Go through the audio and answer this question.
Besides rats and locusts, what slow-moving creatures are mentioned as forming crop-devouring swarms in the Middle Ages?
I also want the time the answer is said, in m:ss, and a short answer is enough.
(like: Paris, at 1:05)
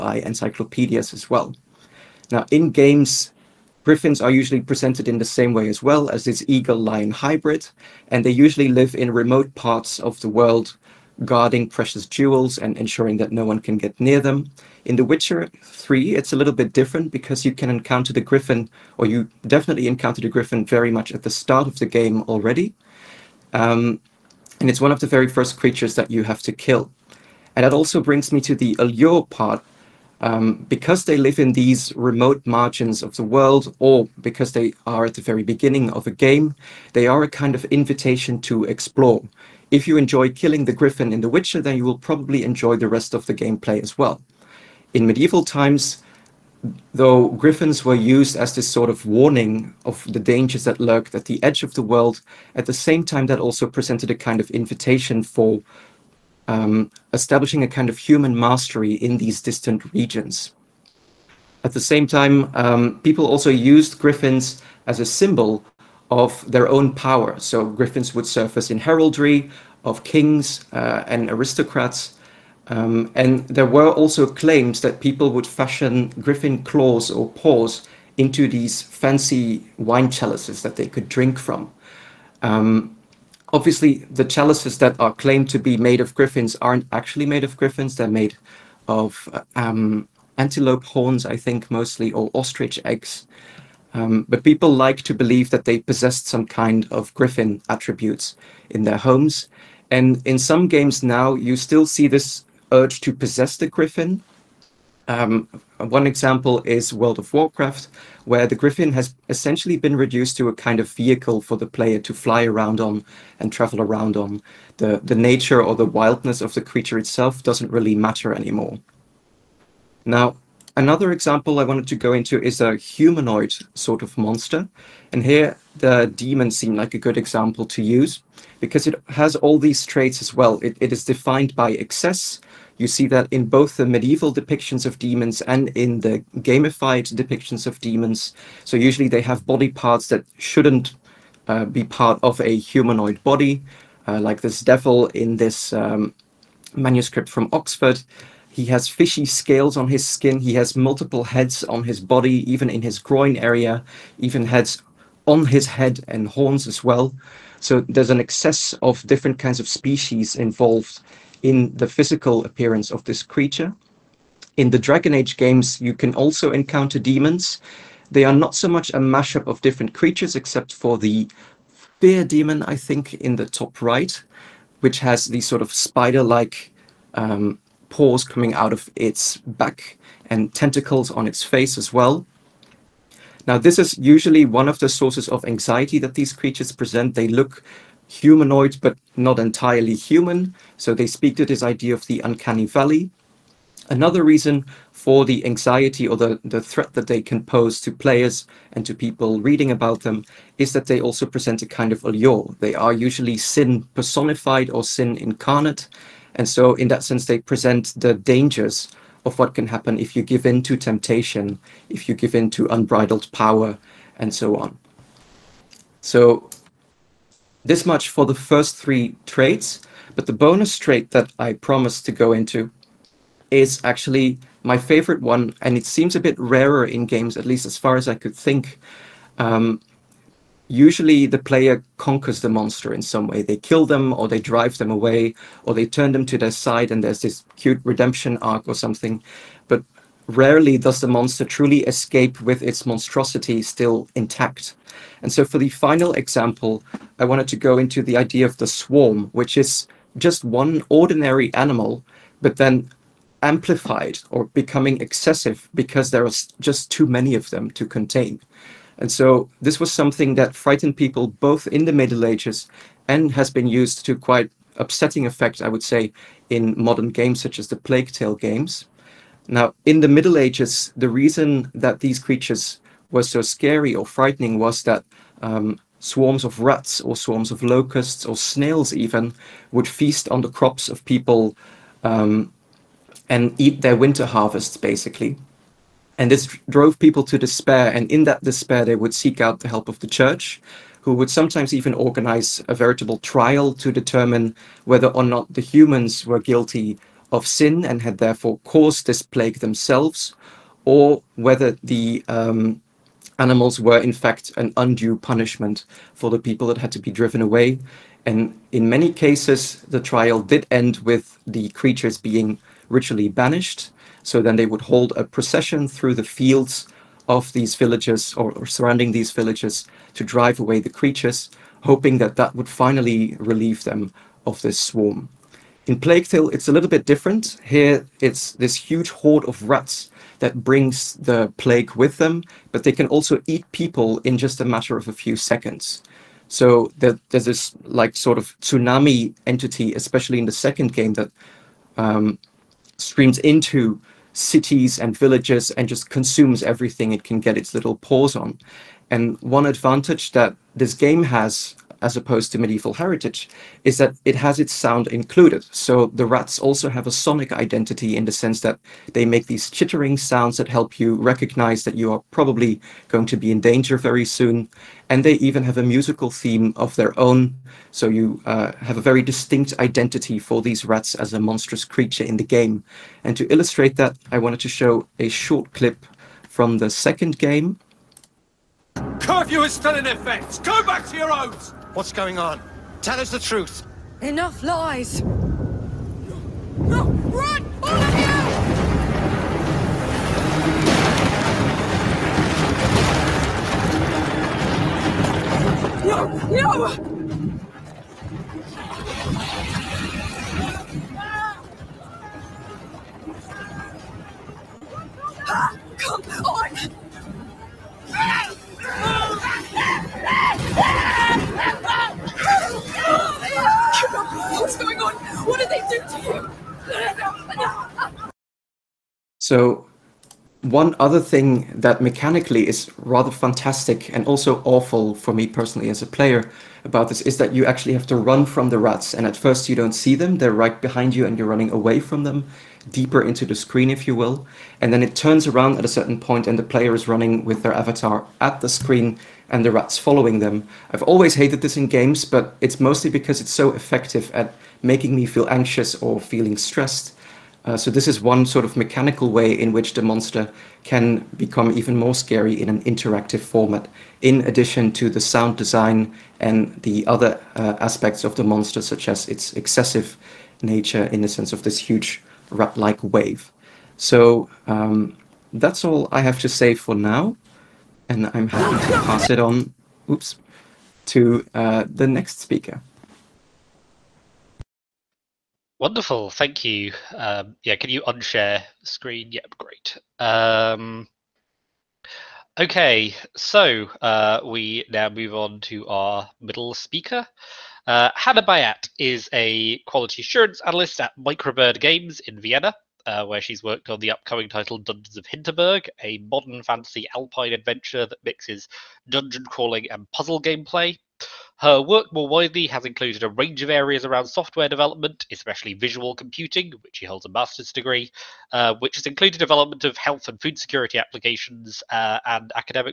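snails, at 4:38.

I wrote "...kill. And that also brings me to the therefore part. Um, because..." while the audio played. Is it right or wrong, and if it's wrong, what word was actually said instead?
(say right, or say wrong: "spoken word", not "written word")
wrong: "allure", not "therefore".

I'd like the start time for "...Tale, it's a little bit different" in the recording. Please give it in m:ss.
5:26.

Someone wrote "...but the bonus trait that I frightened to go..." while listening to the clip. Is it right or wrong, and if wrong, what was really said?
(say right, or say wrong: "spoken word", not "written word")
wrong: "promised", not "frightened".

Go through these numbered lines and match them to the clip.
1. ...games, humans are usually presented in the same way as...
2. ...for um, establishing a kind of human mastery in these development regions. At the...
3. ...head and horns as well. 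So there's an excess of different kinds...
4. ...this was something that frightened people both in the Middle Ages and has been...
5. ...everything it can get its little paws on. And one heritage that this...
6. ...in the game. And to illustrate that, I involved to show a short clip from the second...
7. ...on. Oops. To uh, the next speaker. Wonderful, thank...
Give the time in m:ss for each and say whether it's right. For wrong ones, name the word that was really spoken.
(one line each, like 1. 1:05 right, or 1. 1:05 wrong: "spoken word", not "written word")
1. 0:02 wrong: "griffins", not "humans"
2. 0:55 wrong: "distant", not "development"
3. 2:35 right
4. 4:19 right
5. 5:46 wrong: "advantage", not "heritage"
6. 6:12 wrong: "wanted", not "involved"
7. 7:49 right.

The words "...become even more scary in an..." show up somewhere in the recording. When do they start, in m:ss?
7:31.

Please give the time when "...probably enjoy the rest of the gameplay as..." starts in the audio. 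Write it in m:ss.
0:41.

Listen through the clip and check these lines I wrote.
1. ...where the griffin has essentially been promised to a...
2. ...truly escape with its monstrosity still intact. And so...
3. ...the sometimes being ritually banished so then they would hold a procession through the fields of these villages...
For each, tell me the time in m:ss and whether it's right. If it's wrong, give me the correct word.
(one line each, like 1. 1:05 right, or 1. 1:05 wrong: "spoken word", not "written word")
1. 1:48 wrong: "reduced", not "promised"
2. 4:01 right
3. 5:11 wrong: "creatures", not "sometimes".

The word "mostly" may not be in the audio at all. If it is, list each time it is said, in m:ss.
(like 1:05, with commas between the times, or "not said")
1:31, 7:22.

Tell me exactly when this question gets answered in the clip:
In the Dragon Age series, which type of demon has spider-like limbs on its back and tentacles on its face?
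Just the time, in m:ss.
2:51.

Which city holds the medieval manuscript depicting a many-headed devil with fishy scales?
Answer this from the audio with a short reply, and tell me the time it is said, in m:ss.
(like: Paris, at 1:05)
Oxford, at 2:27.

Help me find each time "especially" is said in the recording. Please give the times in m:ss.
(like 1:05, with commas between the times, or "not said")
5:39, 8:25.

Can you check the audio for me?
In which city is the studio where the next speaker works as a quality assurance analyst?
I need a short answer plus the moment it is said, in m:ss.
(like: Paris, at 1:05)
Vienna, at 8:12.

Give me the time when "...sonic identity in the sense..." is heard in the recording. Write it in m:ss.
5:57.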